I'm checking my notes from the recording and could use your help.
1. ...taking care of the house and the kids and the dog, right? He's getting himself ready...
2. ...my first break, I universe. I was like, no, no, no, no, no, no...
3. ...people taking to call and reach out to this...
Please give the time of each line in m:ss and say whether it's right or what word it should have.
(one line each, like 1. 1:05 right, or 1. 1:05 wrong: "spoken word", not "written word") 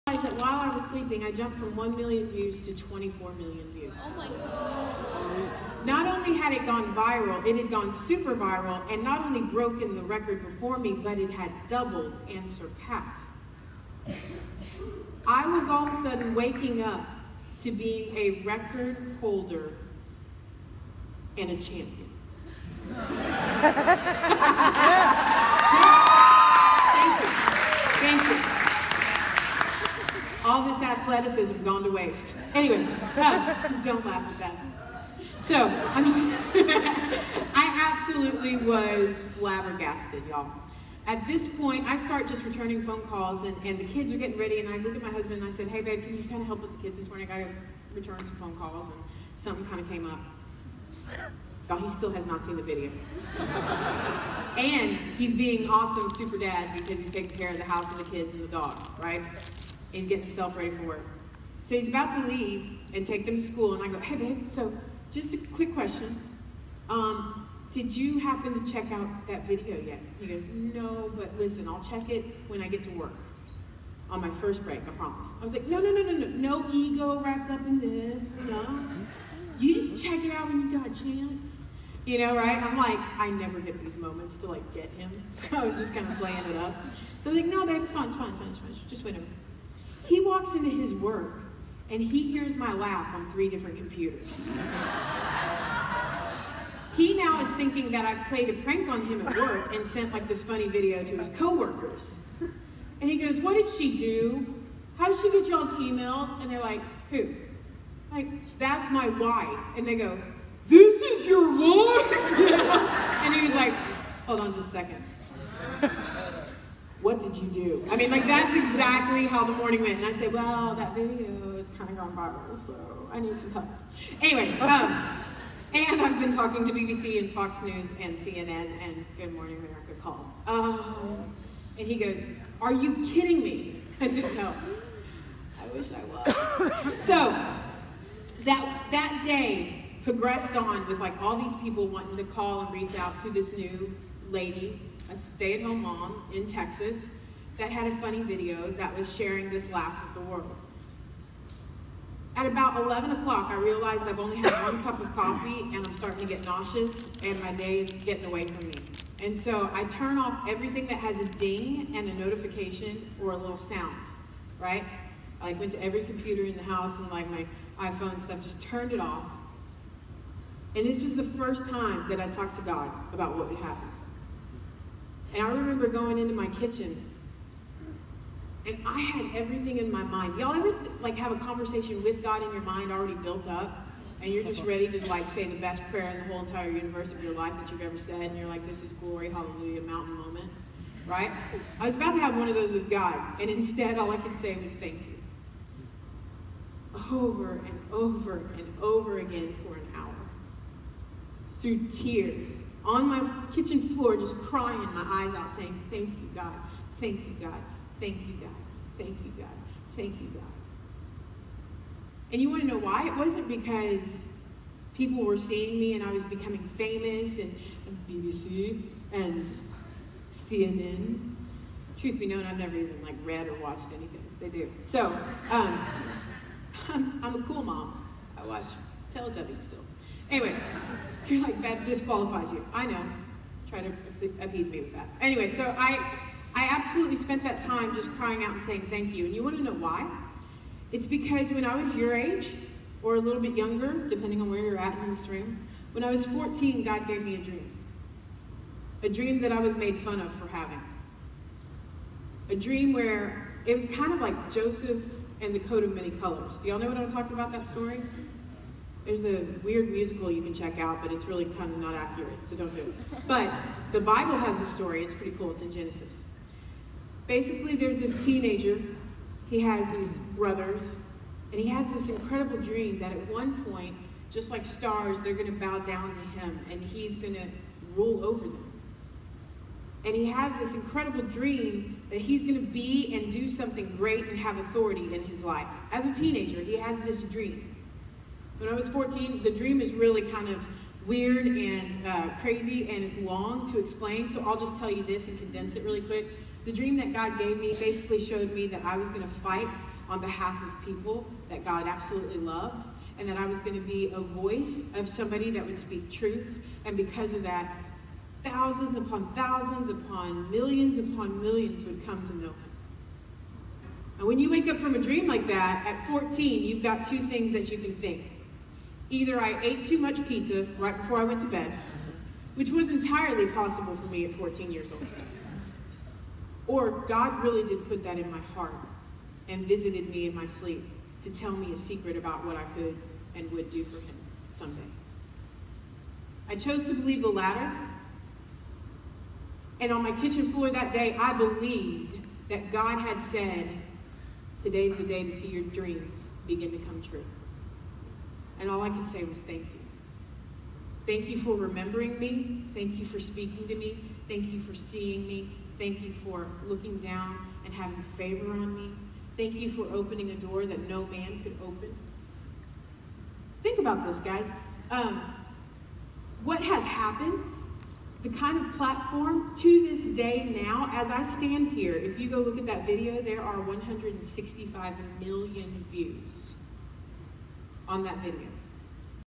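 1. 0:57 right
2. 1:14 wrong: "promise", not "universe"
3. 2:21 wrong: "wanting", not "taking".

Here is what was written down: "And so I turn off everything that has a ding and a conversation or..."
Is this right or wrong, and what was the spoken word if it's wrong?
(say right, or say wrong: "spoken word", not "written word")
wrong: "notification", not "conversation".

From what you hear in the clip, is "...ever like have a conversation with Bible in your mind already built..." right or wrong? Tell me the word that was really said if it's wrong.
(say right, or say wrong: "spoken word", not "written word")
wrong: "God", not "Bible".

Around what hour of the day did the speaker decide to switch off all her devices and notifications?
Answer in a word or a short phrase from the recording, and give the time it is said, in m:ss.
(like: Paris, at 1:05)
11 o'clock, at 2:32.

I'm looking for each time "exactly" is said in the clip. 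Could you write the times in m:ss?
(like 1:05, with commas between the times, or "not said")
1:58.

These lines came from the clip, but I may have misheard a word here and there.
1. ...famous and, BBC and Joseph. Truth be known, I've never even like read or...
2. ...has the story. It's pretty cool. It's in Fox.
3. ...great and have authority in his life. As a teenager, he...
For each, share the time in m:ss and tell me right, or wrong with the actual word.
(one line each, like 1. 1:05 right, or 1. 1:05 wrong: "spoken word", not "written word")
1. 3:36 wrong: "CNN", not "Joseph"
2. 4:24 wrong: "Genesis", not "Fox"
3. 4:43 right.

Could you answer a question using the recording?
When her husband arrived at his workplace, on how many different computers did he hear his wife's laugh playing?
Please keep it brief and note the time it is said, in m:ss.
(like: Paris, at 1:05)
3, at 1:33.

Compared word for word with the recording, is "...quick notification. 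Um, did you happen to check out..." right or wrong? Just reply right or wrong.
wrong.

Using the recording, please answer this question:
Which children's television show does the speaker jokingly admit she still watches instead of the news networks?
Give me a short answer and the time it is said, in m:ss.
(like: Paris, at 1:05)
Teletubbies, at 3:49.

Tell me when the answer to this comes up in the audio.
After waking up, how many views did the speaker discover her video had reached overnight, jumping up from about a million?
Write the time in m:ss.
0:02.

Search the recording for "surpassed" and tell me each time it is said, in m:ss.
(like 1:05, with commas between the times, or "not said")
0:12.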